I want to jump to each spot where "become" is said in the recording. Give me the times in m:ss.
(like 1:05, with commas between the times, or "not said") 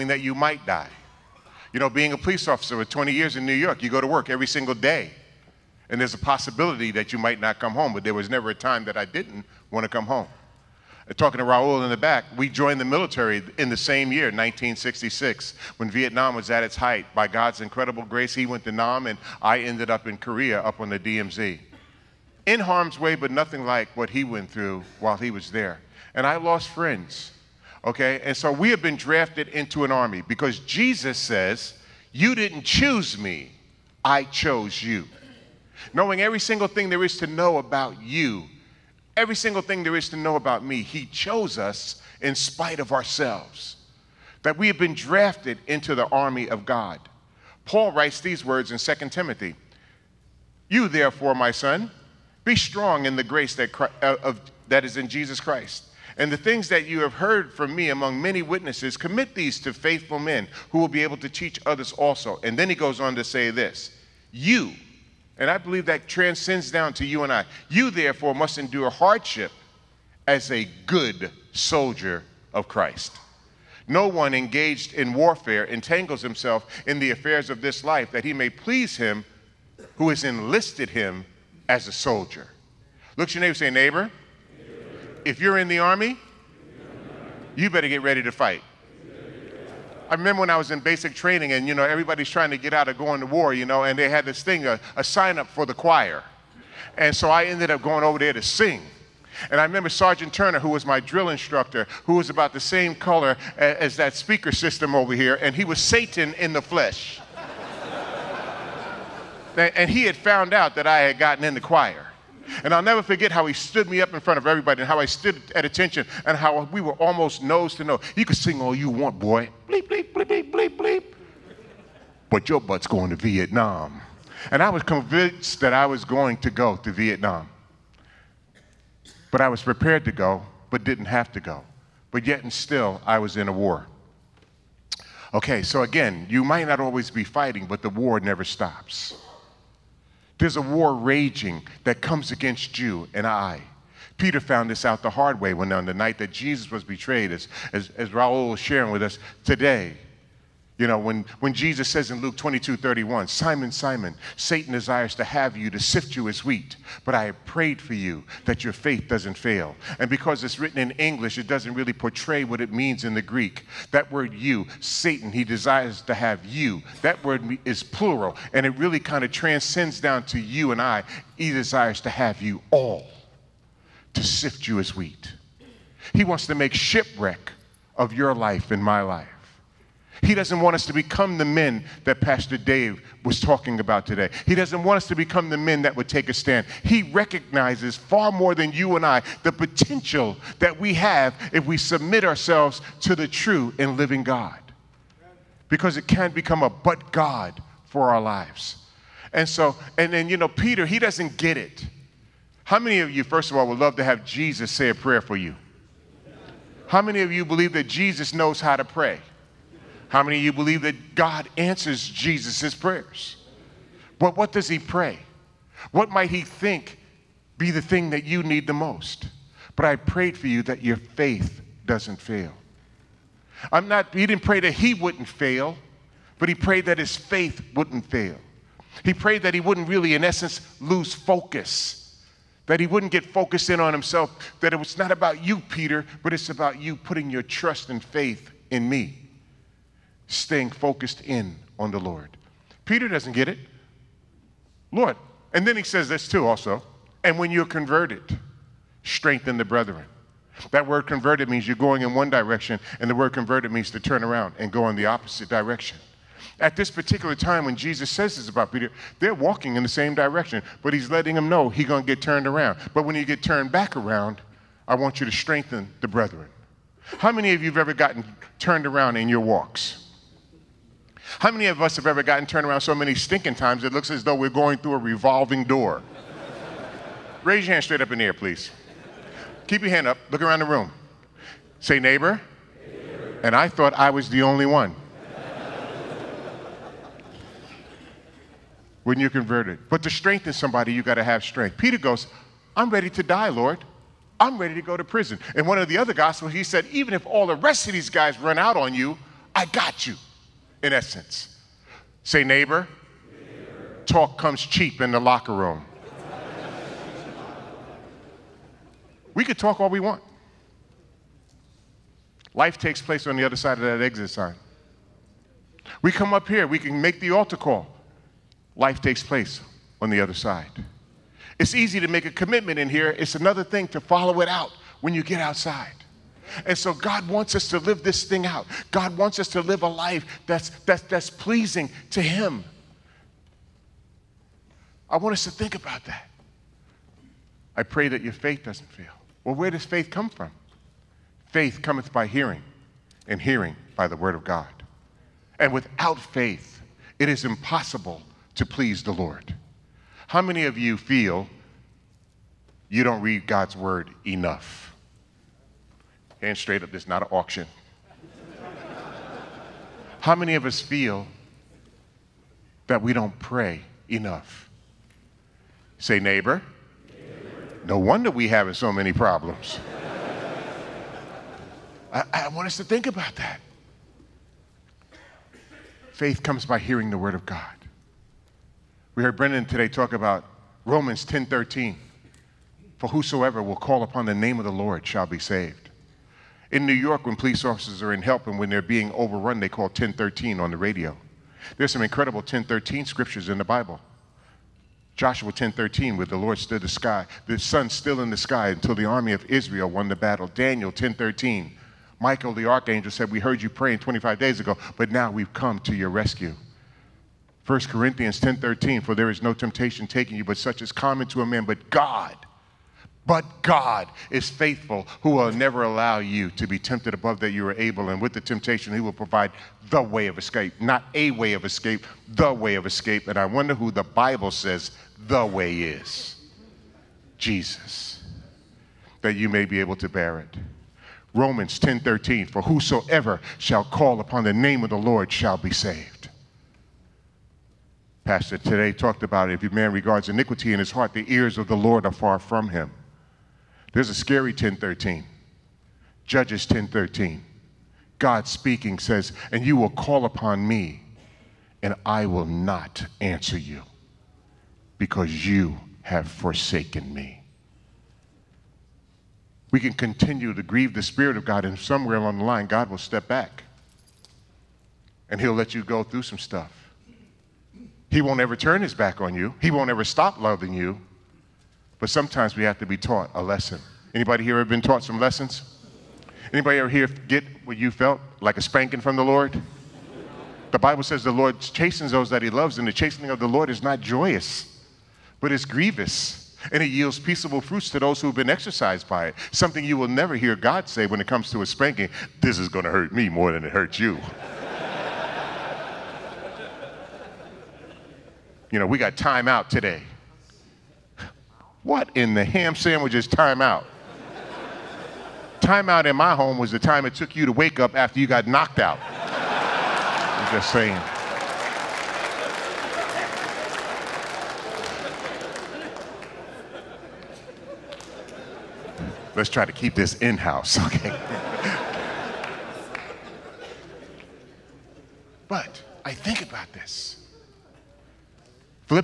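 3:00, 3:05, 3:16.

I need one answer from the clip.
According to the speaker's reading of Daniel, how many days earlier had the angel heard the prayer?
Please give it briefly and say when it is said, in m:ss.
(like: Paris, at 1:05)
25 days, at 6:43.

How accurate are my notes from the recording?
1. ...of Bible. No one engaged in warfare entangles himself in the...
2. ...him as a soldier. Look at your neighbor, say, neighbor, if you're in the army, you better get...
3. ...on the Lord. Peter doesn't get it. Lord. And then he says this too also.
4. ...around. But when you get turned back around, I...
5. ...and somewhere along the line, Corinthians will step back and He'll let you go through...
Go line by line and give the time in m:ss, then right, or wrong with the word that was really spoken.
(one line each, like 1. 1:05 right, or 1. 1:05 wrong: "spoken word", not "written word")
1. 1:12 wrong: "Christ", not "Bible"
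2. 1:20 right
3. 4:01 right
4. 4:22 right
5. 7:41 wrong: "God", not "Corinthians".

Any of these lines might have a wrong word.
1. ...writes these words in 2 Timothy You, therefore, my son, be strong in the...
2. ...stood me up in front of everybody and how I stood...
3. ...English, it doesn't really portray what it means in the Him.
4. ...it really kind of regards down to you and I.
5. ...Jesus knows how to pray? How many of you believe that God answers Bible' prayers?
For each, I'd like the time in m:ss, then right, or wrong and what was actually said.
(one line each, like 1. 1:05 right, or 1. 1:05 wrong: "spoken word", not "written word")
1. 0:47 right
2. 1:53 right
3. 2:40 wrong: "Greek", not "Him"
4. 2:48 wrong: "transcends", not "regards"
5. 3:27 wrong: "Jesus", not "Bible".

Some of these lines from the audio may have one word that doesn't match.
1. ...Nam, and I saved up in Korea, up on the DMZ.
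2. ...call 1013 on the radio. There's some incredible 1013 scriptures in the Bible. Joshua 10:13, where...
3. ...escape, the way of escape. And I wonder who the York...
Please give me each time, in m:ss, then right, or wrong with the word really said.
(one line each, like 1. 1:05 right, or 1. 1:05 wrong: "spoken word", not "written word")
1. 0:18 wrong: "ended", not "saved"
2. 6:29 right
3. 7:01 wrong: "Bible", not "York".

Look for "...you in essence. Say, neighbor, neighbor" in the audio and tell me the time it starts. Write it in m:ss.
5:00.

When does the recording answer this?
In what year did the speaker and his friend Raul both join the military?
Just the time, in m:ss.
0:14.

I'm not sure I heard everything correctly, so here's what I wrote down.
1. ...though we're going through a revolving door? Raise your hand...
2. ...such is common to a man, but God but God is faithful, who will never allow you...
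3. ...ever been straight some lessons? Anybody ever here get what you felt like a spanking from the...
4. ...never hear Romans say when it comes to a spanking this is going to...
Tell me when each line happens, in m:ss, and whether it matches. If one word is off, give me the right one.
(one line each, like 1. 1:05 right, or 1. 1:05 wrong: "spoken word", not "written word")
1. 4:34 right
2. 6:50 right
3. 7:54 wrong: "taught", not "straight"
4. 8:10 wrong: "God", not "Romans".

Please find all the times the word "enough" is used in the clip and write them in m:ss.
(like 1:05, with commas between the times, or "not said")
5:54, 6:04.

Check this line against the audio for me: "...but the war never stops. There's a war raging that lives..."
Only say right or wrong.
wrong.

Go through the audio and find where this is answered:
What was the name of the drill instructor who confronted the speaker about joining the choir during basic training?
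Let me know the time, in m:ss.
1:39.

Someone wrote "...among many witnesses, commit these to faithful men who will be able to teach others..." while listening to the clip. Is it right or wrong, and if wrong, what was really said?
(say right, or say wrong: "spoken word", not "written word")
right.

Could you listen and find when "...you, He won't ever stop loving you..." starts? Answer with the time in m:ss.
7:49.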